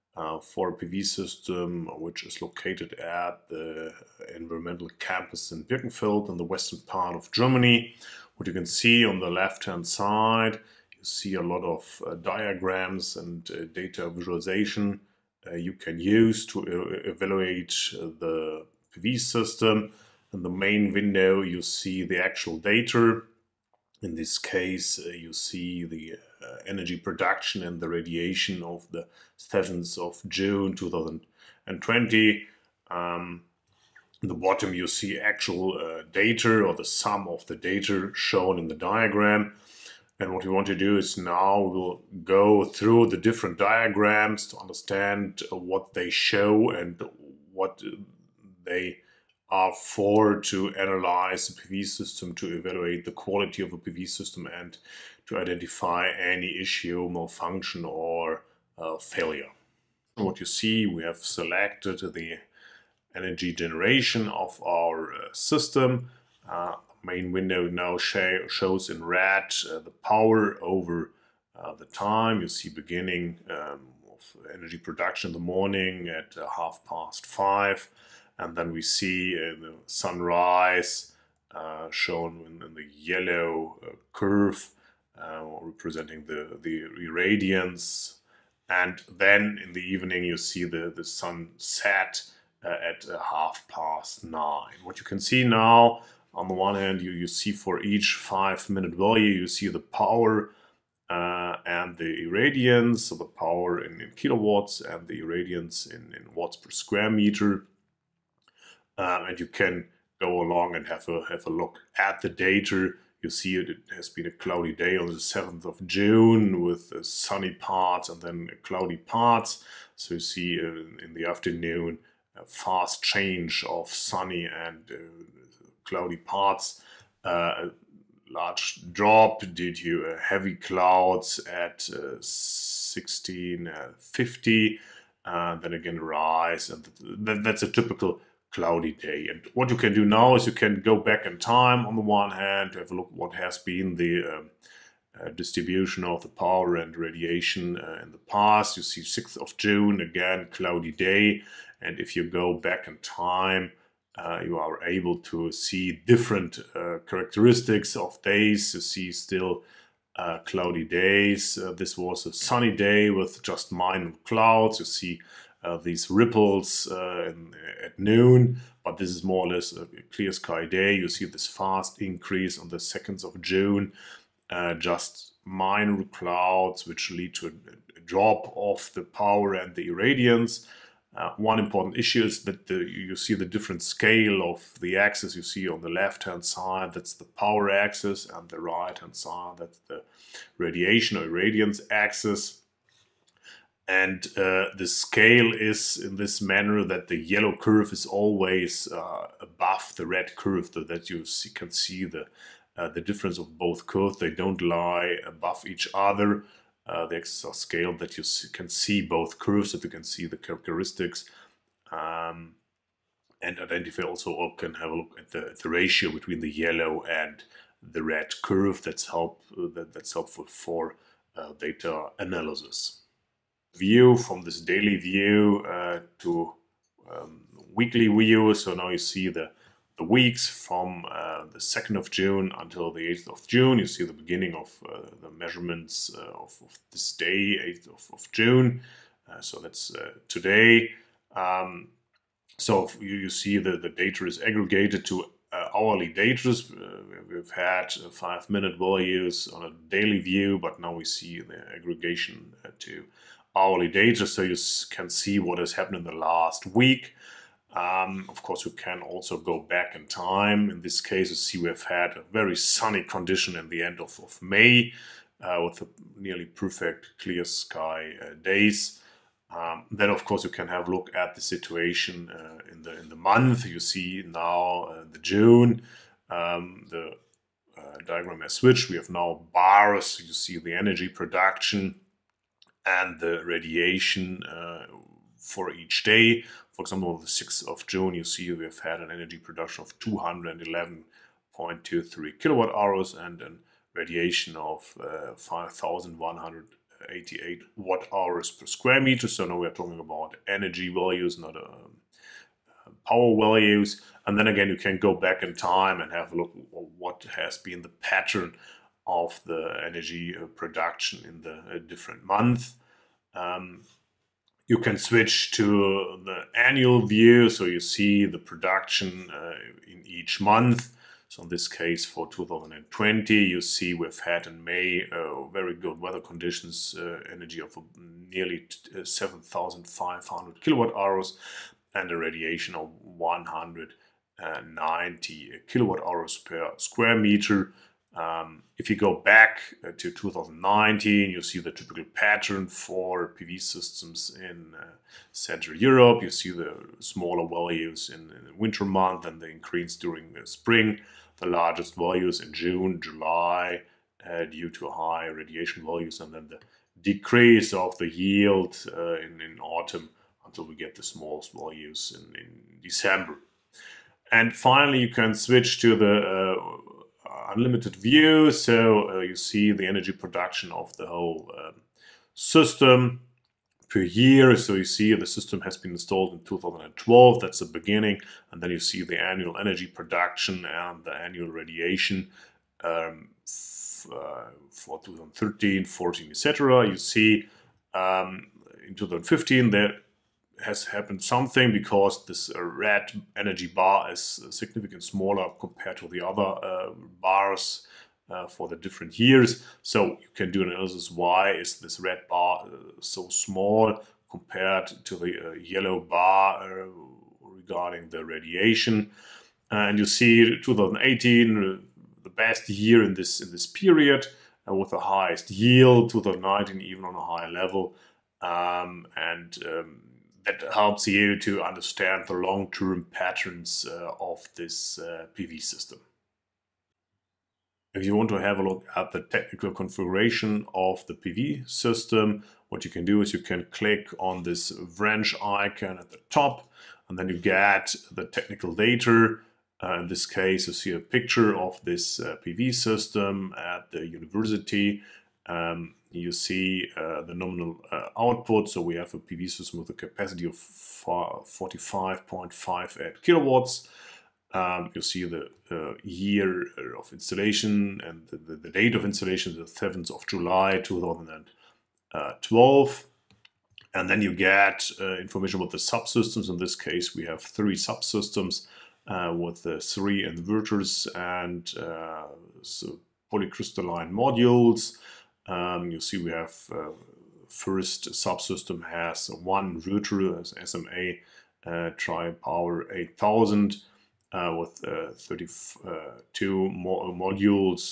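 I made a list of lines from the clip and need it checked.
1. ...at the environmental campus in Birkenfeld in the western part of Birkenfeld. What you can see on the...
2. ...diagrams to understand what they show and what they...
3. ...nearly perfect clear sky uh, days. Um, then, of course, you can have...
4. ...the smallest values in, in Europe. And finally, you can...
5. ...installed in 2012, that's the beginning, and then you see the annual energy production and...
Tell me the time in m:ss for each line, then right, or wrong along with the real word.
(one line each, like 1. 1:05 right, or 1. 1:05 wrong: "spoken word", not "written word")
1. 0:02 wrong: "Germany", not "Birkenfeld"
2. 0:43 right
3. 4:26 right
4. 6:00 wrong: "December", not "Europe"
5. 6:15 right.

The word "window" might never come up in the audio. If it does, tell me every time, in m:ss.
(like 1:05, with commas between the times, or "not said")
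0:20, 1:07.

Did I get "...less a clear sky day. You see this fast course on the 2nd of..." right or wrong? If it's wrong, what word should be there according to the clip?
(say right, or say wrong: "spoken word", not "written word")
wrong: "increase", not "course".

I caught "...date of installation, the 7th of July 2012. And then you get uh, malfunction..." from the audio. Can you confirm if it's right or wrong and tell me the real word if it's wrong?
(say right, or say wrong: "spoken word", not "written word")
wrong: "information", not "malfunction".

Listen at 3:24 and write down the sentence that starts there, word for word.
They don't lie above each other.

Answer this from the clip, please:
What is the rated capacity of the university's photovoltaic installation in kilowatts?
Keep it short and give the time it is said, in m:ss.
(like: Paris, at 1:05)
45.58 kW, at 7:30.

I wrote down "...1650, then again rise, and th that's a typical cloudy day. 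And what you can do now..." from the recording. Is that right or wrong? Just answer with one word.
right.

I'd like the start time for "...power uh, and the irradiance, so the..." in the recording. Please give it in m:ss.
1:39.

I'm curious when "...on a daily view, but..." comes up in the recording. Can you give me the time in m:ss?
4:09.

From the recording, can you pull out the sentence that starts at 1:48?
Uh, and you can go along and have a have a look at the data.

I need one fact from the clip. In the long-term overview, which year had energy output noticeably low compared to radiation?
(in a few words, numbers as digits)
2015.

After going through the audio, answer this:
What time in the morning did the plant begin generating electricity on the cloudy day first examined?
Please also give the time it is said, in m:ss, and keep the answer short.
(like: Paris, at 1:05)
half past five, at 1:16.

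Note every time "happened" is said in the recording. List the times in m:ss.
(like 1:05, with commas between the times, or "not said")
4:15, 6:30.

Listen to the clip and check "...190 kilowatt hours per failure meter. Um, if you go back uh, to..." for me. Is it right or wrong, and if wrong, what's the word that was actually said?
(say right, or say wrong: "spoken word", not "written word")
wrong: "square", not "failure".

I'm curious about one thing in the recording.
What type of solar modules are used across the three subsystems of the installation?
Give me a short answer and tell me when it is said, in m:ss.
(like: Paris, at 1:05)
polycrystalline, at 7:53.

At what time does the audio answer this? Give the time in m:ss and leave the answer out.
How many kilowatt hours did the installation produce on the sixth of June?
4:49.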